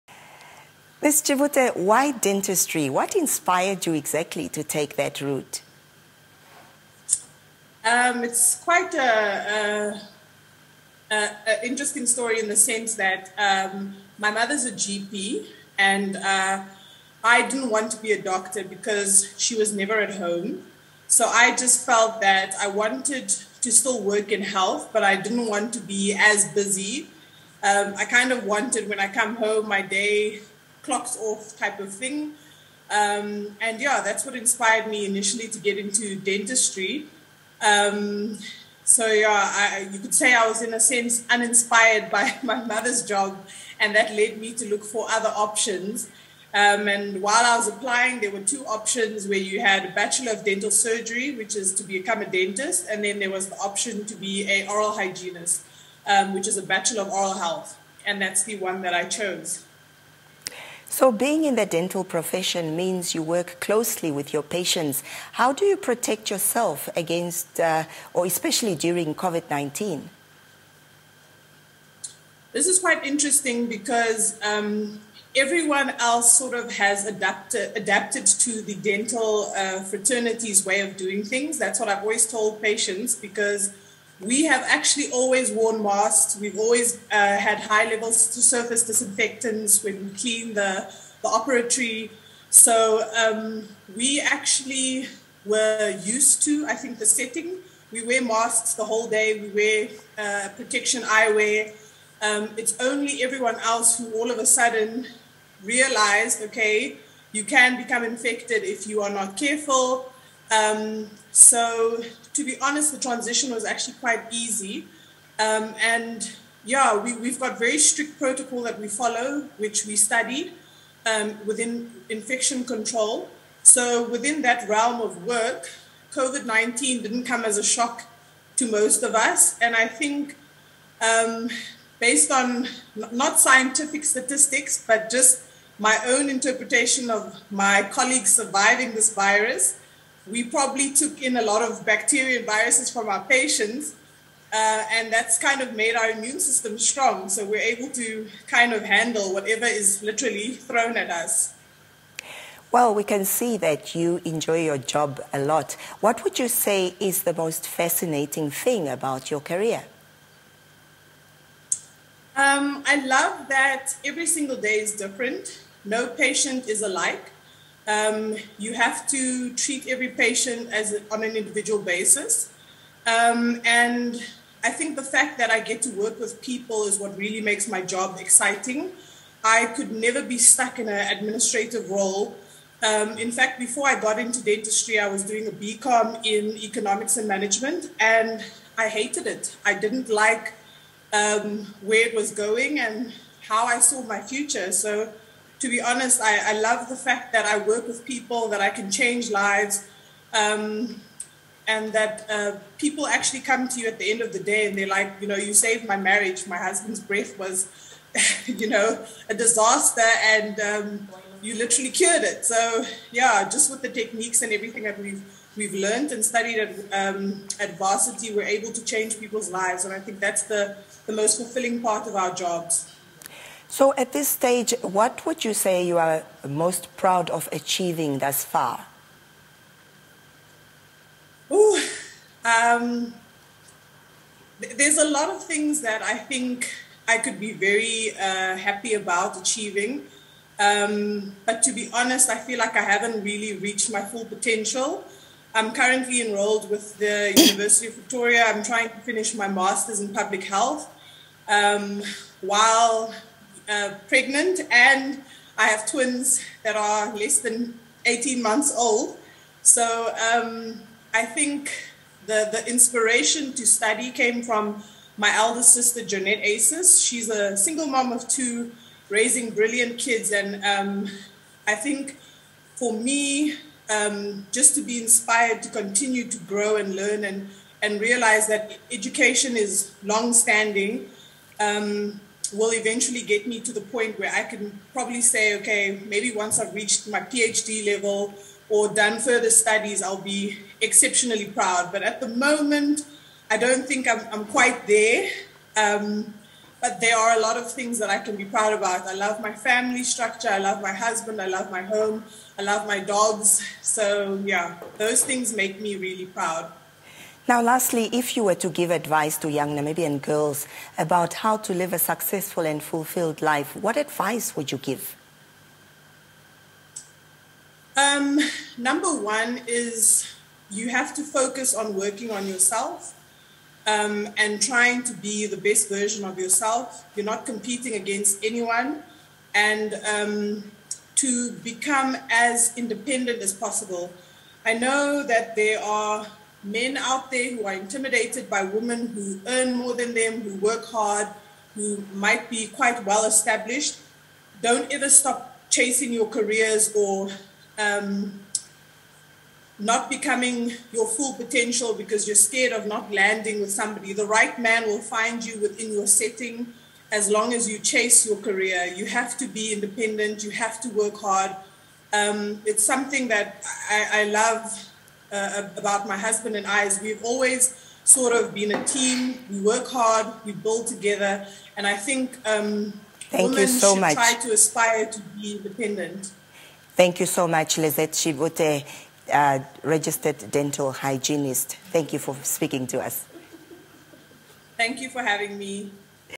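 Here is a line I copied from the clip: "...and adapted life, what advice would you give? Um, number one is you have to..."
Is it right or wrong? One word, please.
wrong.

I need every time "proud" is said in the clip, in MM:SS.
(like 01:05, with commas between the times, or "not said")
03:46, 04:51, 04:58, 05:06.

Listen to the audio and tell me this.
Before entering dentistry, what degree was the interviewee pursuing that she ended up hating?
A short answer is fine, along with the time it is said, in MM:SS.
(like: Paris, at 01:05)
BCom in economics and management, at 03:05.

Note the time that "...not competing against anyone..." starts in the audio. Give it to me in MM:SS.
05:27.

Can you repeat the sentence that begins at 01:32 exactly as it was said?
So um, we actually were used to, I think, the setting.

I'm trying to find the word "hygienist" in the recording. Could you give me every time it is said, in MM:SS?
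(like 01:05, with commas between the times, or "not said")
00:54, 06:20.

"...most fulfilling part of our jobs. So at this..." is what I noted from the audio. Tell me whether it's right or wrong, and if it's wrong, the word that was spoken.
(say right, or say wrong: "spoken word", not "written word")
right.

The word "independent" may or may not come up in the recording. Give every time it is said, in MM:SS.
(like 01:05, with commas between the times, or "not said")
05:32, 05:59, 06:15.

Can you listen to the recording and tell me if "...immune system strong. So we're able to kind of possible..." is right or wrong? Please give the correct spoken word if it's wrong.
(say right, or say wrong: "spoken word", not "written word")
wrong: "handle", not "possible".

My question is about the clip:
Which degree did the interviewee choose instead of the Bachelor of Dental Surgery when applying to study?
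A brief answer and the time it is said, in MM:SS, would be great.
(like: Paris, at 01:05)
Bachelor of Oral Health, at 00:56.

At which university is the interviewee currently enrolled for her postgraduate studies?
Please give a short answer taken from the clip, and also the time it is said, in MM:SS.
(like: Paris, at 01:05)
University of Victoria, at 04:07.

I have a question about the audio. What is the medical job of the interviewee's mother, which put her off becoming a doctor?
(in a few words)
GP.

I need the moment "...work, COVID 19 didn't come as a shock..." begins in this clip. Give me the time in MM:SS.
02:05.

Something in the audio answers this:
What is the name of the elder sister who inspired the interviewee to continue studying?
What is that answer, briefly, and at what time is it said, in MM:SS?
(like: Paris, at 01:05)
Jeanette Aces, at 04:26.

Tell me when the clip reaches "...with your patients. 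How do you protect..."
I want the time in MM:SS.
01:04.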